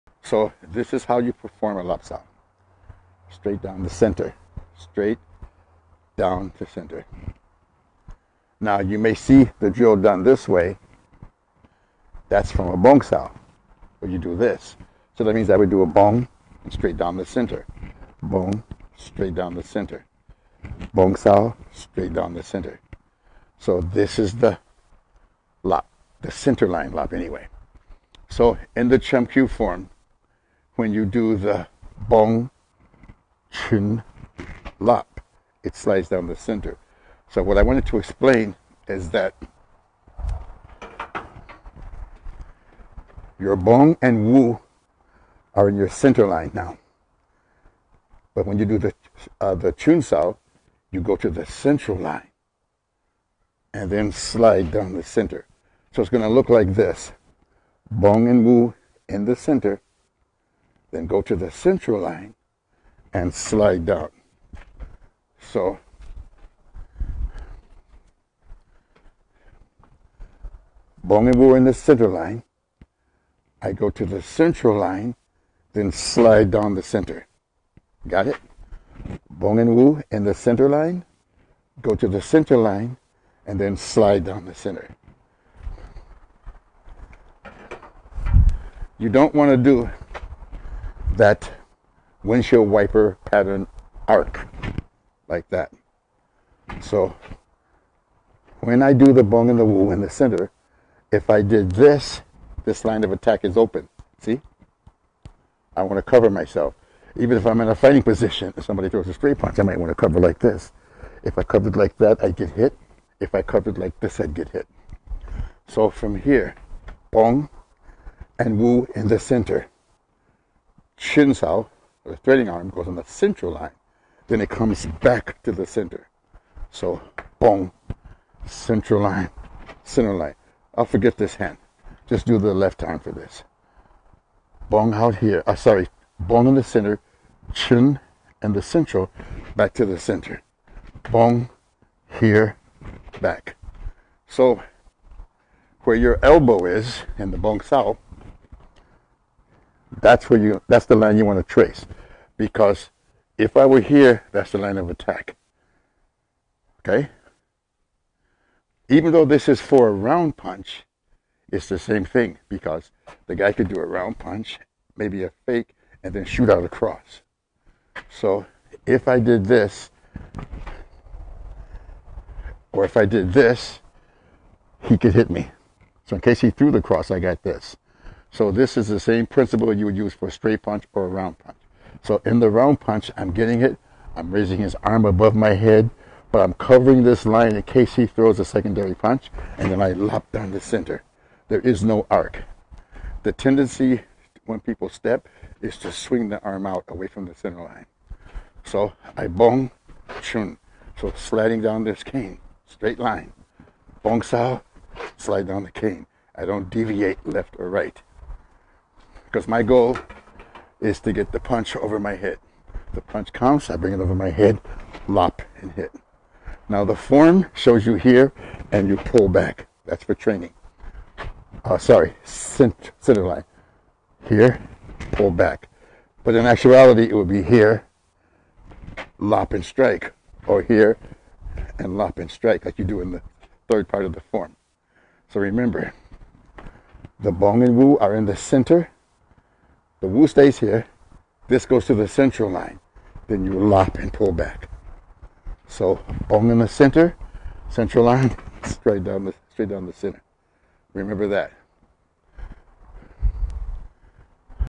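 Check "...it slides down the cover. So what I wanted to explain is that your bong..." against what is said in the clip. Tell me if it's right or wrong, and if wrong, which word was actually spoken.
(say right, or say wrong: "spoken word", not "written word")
wrong: "center", not "cover".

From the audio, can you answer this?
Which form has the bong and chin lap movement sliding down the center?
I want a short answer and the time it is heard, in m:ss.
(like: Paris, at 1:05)
Chum form, at 0:28.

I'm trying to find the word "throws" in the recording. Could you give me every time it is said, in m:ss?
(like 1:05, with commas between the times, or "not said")
1:48, 3:08.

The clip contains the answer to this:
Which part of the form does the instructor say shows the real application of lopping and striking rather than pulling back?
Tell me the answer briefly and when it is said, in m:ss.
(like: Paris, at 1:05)
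The third part, at 3:53.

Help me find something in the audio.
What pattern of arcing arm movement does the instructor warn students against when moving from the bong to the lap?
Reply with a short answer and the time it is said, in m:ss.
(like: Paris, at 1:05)
Windshield wiper, at 1:32.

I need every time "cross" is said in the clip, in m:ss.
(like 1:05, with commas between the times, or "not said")
2:46, 2:56.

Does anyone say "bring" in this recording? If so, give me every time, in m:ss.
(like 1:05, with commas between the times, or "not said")
3:33.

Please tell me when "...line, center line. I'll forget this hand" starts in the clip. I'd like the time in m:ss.
2:09.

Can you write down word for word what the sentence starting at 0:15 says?
So that means I would do a bong straight down the center.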